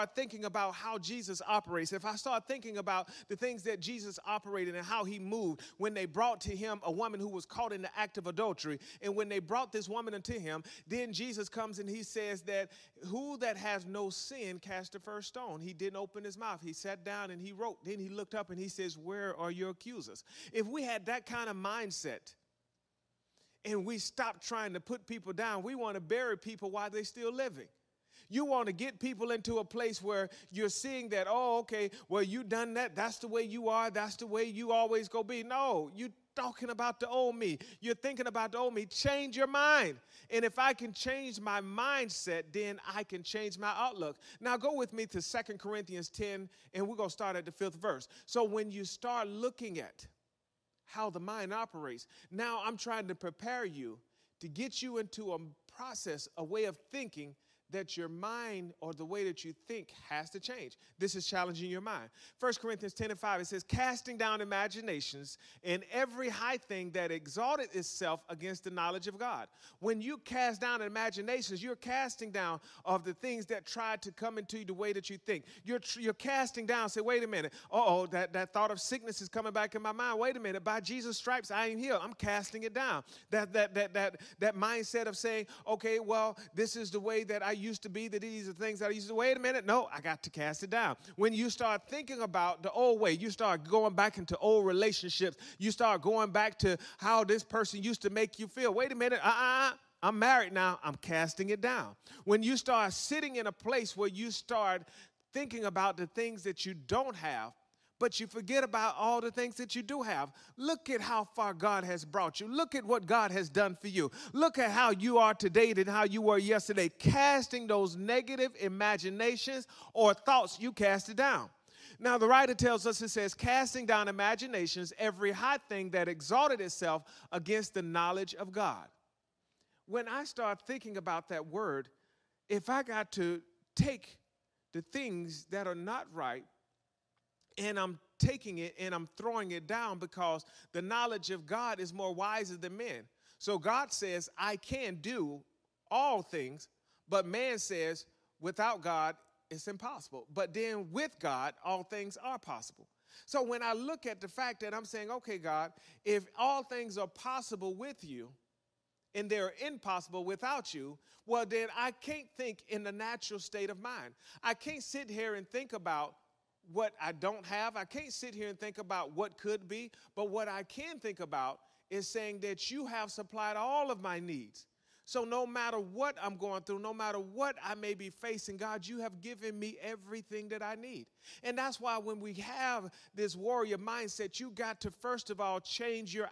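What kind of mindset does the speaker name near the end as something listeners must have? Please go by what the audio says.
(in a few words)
warrior mindset.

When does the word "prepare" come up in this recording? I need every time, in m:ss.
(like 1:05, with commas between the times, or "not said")
0:53.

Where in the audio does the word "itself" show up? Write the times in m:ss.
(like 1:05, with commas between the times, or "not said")
1:07, 2:06.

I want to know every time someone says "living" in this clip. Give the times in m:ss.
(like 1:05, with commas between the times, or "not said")
0:27.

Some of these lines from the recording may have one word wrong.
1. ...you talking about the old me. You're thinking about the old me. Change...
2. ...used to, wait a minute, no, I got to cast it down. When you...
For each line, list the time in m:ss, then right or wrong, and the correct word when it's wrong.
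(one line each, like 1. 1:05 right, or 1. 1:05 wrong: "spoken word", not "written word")
1. 0:35 right
2. 1:28 right.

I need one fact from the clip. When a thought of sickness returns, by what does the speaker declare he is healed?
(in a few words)
Jesus' stripes.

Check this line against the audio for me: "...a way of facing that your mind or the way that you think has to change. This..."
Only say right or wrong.
wrong.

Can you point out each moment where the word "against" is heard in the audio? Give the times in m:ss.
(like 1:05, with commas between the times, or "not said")
1:08, 2:07.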